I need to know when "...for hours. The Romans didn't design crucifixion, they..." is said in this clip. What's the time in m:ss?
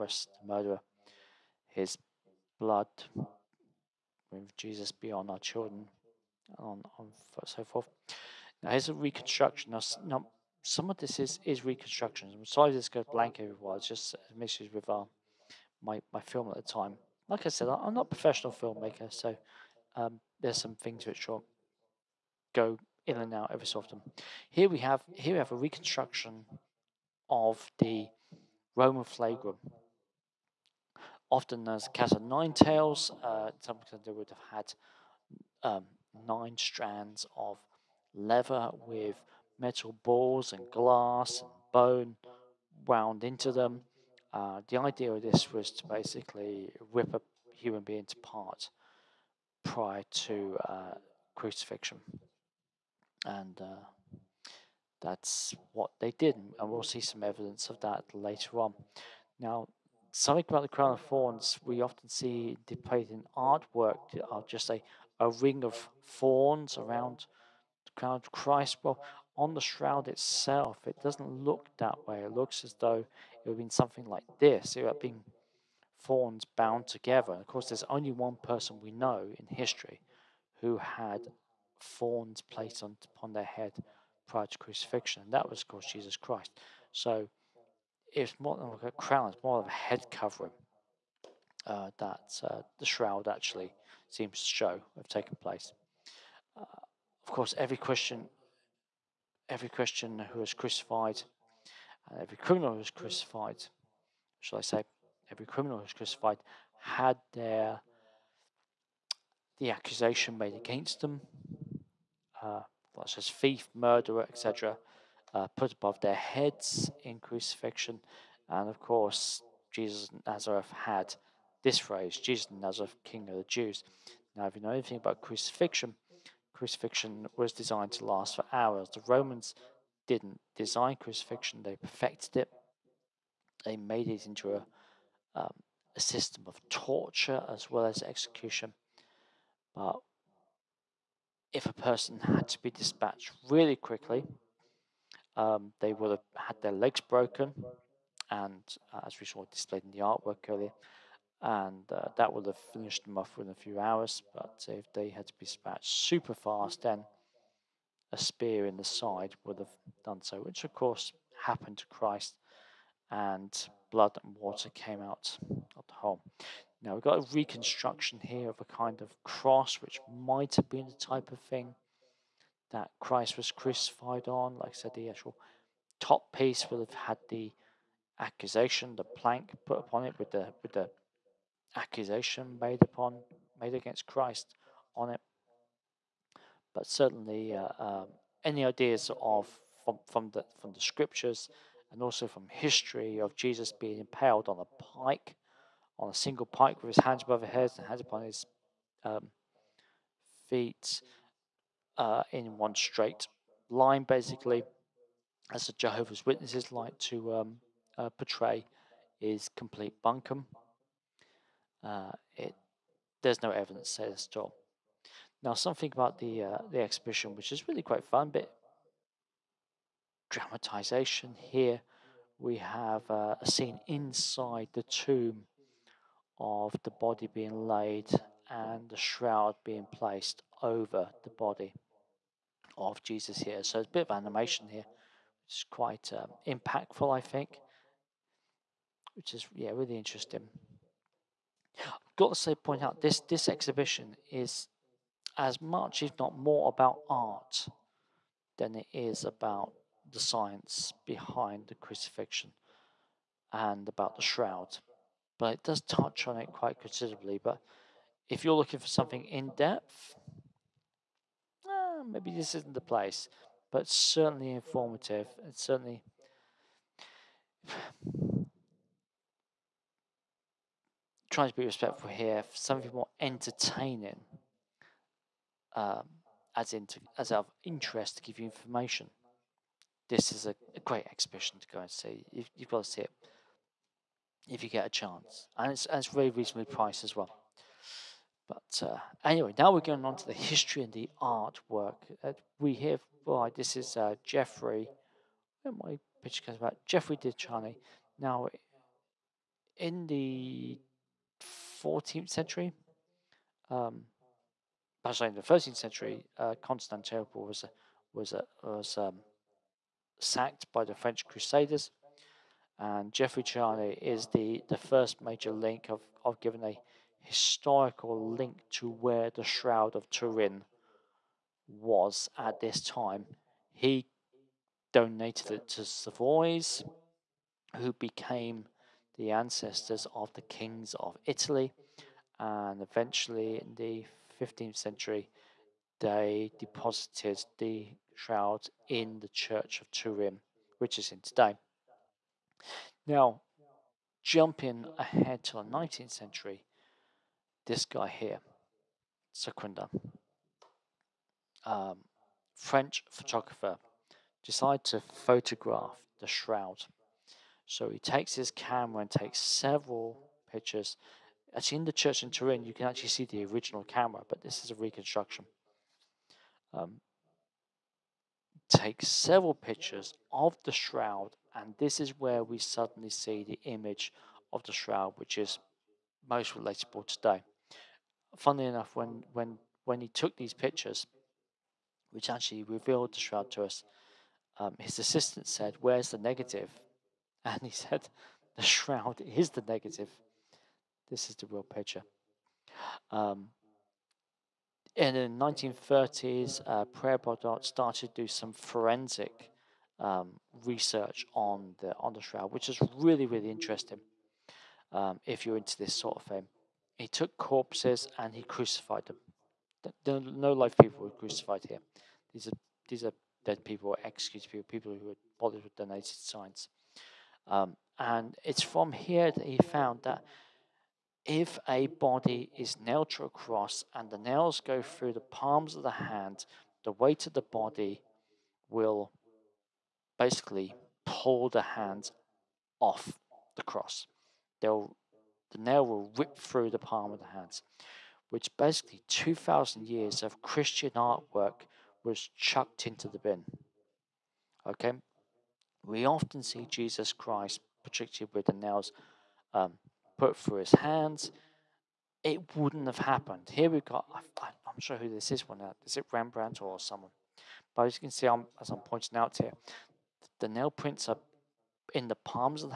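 2:08.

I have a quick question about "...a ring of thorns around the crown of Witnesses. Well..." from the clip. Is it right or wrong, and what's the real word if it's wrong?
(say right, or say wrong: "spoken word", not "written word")
wrong: "Christ", not "Witnesses".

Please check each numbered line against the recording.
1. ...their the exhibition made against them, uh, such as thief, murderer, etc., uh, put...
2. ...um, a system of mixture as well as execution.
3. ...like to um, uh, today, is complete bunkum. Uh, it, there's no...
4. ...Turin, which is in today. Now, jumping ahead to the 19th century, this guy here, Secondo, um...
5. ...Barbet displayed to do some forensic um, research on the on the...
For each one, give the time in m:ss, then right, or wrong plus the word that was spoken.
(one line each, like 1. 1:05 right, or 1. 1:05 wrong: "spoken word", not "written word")
1. 1:47 wrong: "accusation", not "exhibition"
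2. 2:15 wrong: "torture", not "mixture"
3. 3:26 wrong: "portray", not "today"
4. 5:39 right
5. 6:37 wrong: "started", not "displayed".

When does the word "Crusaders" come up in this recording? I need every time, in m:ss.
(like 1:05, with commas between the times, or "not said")
5:11.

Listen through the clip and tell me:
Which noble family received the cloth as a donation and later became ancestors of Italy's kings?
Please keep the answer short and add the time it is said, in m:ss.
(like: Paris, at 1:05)
Savoys, at 5:25.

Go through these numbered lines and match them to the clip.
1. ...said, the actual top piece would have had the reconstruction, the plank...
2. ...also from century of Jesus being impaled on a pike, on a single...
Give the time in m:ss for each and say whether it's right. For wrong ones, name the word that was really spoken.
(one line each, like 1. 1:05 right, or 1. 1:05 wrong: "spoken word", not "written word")
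1. 2:54 wrong: "accusation", not "reconstruction"
2. 3:12 wrong: "history", not "century".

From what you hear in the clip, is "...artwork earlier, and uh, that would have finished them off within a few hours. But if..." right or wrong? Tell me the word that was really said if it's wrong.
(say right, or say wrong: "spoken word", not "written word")
right.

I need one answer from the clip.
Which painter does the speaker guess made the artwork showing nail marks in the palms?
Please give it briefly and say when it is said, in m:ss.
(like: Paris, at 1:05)
Rembrandt, at 7:36.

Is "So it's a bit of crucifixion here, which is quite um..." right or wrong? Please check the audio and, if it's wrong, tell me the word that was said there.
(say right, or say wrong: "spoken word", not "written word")
wrong: "animation", not "crucifixion".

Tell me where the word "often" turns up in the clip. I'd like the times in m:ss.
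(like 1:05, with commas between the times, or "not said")
0:23, 0:31, 1:01, 7:26.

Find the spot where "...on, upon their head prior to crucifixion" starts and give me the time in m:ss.
1:22.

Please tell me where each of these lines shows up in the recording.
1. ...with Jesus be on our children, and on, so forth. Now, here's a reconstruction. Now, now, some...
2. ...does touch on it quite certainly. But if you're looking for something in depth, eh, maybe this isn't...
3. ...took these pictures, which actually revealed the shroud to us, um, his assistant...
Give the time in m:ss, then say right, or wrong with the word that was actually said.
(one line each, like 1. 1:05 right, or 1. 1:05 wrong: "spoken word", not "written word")
1. 0:04 right
2. 4:15 wrong: "considerably", not "certainly"
3. 6:20 right.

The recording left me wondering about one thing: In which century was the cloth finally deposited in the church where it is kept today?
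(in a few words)
15th century.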